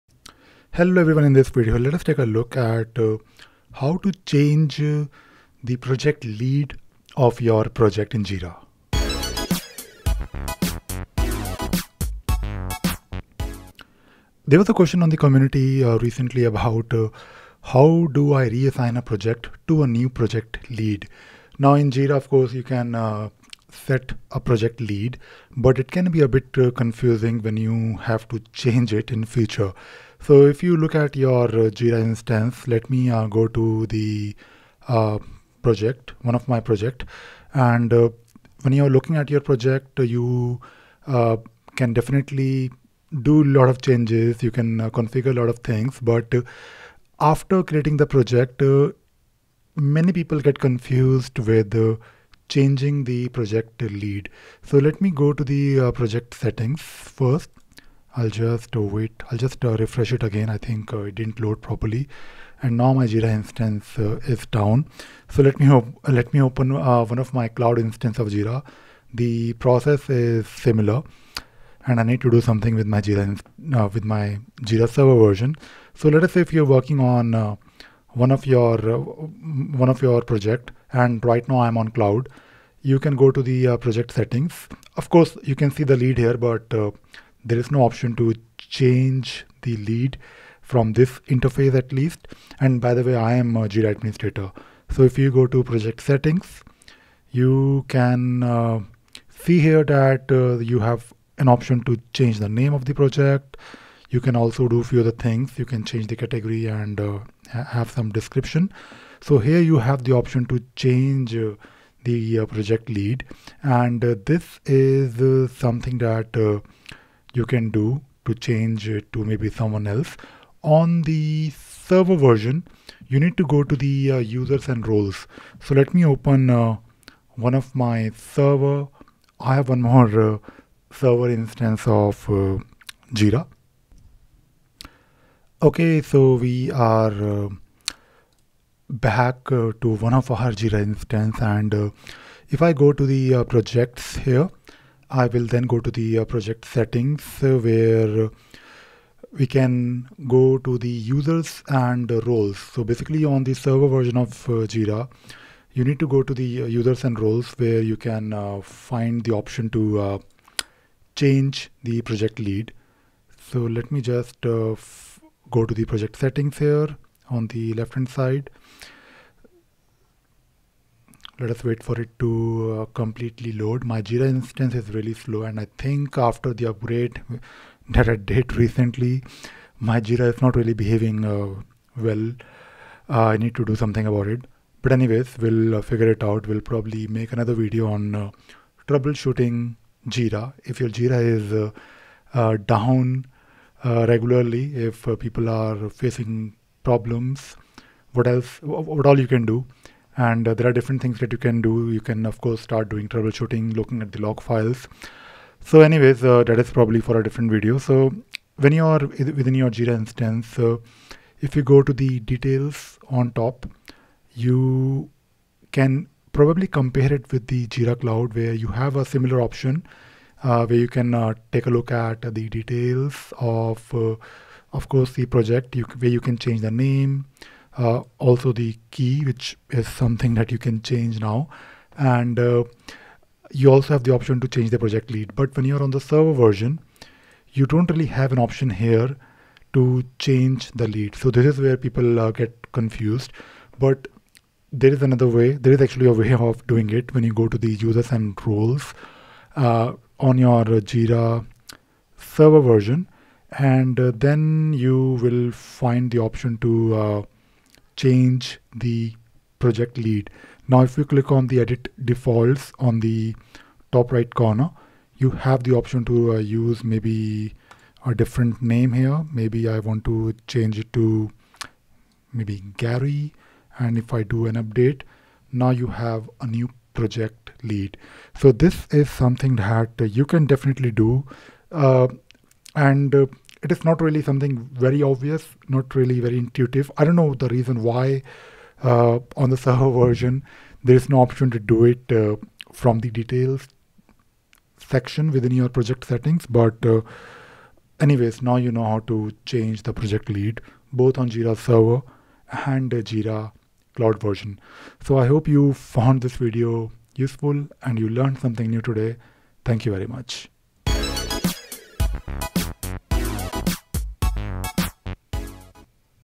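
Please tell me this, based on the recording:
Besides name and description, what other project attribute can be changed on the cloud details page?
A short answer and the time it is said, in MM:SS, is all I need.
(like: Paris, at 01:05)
category, at 01:46.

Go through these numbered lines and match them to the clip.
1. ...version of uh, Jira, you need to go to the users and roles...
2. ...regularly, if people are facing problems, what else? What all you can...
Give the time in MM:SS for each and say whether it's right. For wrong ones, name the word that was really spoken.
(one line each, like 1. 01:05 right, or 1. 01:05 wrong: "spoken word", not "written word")
1. 02:33 right
2. 03:14 right.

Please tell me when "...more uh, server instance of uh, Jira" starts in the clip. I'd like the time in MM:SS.
02:09.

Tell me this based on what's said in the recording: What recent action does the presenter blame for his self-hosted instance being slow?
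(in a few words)
the upgrade.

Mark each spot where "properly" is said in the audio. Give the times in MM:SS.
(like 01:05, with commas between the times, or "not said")
01:01.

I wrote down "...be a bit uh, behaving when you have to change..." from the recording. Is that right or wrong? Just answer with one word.
wrong.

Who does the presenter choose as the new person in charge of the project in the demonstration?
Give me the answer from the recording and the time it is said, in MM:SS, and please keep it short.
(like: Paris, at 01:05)
Gary, at 04:32.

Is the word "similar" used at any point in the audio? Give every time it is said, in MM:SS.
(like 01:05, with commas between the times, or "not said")
01:10, 03:39.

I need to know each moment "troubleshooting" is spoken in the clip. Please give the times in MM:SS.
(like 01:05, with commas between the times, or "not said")
03:08, 03:23.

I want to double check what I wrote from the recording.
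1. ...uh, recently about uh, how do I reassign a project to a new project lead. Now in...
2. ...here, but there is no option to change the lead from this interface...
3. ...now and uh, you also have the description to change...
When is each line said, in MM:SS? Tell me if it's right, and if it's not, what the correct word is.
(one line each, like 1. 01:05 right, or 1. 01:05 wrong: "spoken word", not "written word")
1. 00:15 right
2. 01:26 right
3. 03:51 wrong: "option", not "description".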